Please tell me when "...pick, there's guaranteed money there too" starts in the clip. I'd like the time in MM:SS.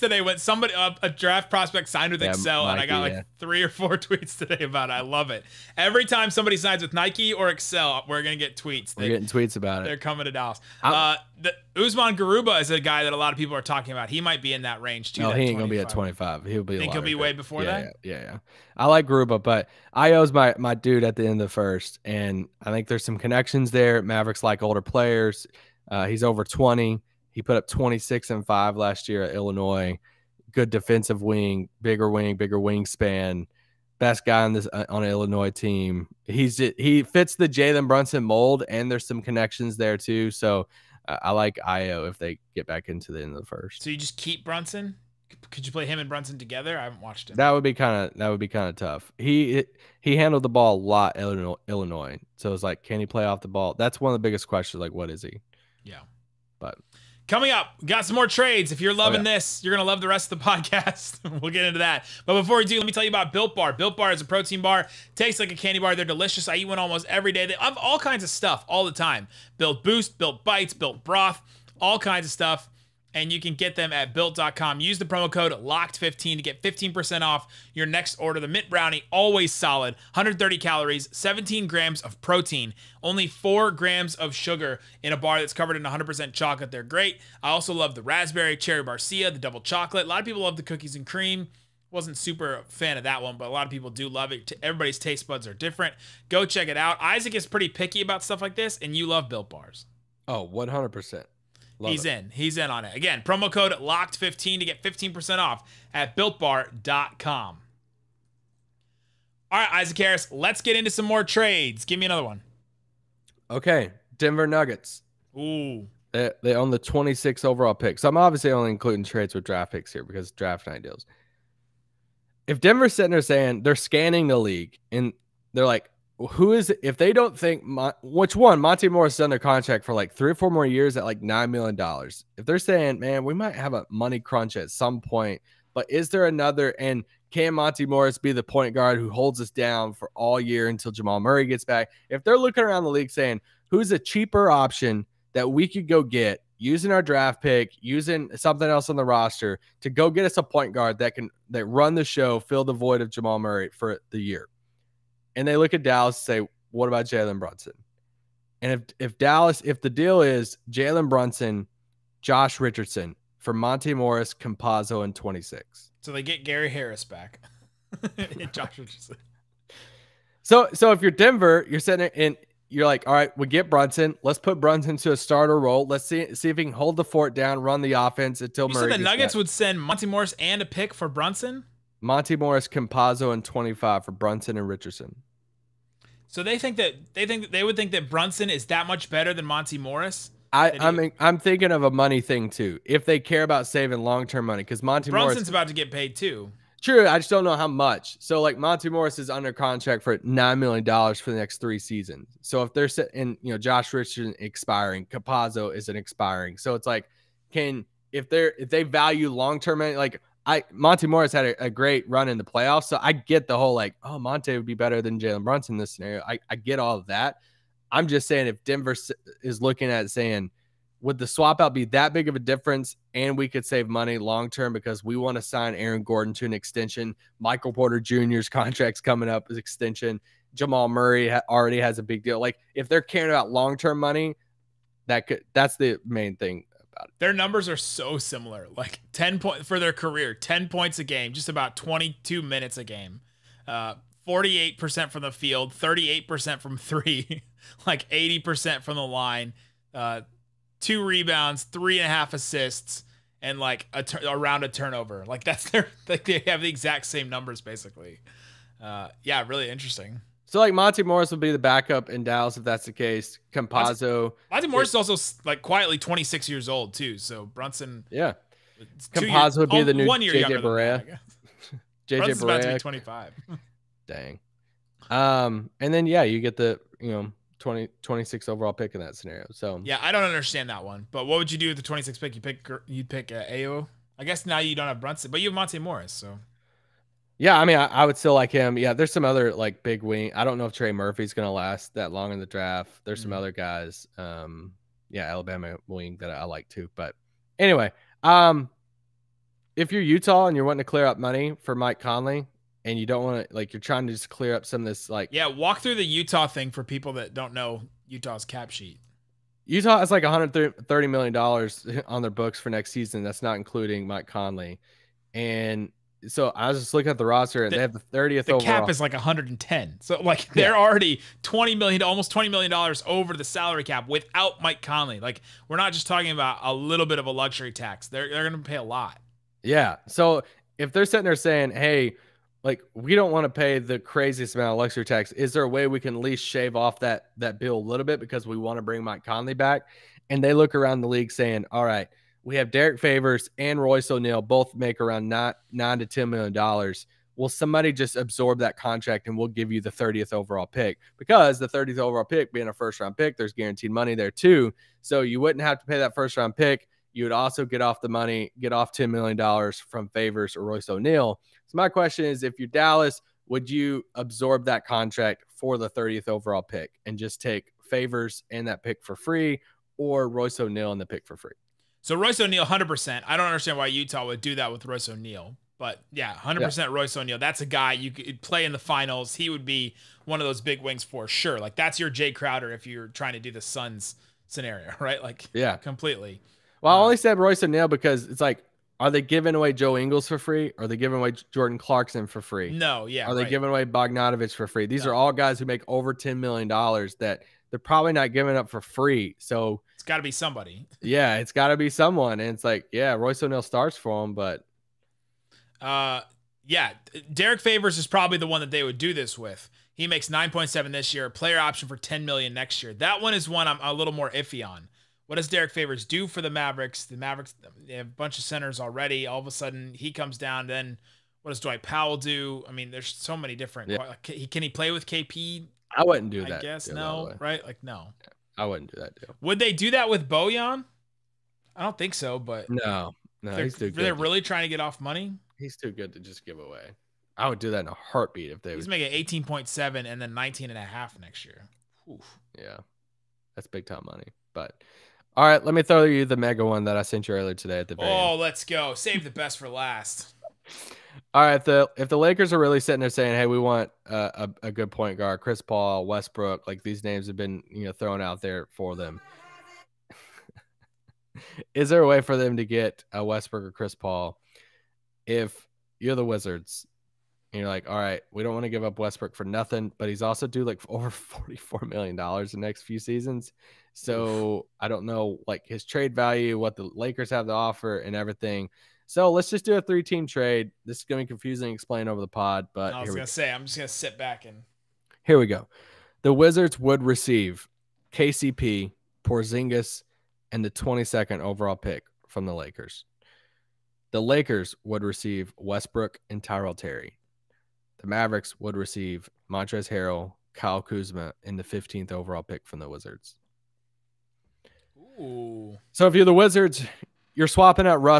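05:53.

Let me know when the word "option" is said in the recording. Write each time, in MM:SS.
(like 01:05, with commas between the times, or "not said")
02:24, 06:51.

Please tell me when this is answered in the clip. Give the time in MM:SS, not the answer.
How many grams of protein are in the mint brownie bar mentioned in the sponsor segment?
01:21.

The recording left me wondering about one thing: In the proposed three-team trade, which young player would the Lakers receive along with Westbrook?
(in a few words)
Tyrell Terry.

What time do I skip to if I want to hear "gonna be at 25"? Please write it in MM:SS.
00:15.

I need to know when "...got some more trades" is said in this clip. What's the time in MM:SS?
00:57.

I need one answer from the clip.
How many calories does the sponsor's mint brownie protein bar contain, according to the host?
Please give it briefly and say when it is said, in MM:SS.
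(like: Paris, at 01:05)
130, at 01:20.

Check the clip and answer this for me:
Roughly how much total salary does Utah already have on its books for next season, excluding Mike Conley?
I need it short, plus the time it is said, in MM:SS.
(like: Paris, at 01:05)
130 million dollars, at 05:10.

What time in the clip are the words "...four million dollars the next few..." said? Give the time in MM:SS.
07:51.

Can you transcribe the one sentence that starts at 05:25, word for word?
Like we're not just talking about a little bit of a luxury tax.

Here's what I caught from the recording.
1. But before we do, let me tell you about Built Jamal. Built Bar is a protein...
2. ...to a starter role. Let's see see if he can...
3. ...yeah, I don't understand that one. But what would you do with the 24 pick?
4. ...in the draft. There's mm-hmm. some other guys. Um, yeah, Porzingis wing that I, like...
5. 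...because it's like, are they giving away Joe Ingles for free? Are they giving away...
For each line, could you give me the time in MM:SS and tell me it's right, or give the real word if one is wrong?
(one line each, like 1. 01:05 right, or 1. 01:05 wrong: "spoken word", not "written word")
1. 01:02 wrong: "Bar", not "Jamal"
2. 02:54 right
3. 04:39 wrong: "26", not "24"
4. 04:52 wrong: "Alabama", not "Porzingis"
5. 06:27 right.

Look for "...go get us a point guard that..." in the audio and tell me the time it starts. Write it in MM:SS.
02:29.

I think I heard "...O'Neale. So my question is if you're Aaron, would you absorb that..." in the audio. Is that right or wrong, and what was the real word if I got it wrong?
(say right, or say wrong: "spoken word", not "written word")
wrong: "Dallas", not "Aaron".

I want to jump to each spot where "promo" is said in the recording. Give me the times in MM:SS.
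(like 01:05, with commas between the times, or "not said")
01:15, 01:43.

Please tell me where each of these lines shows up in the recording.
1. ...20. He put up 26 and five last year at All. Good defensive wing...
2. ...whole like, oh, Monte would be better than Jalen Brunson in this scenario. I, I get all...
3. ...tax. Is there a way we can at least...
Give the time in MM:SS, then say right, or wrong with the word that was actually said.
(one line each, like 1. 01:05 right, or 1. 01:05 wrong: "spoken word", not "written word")
1. 00:26 wrong: "Illinois", not "All"
2. 03:33 right
3. 05:35 right.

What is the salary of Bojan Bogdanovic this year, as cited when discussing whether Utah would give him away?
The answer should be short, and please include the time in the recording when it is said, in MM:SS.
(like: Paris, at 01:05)
18.7 million, at 07:19.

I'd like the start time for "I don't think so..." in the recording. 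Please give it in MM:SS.
07:11.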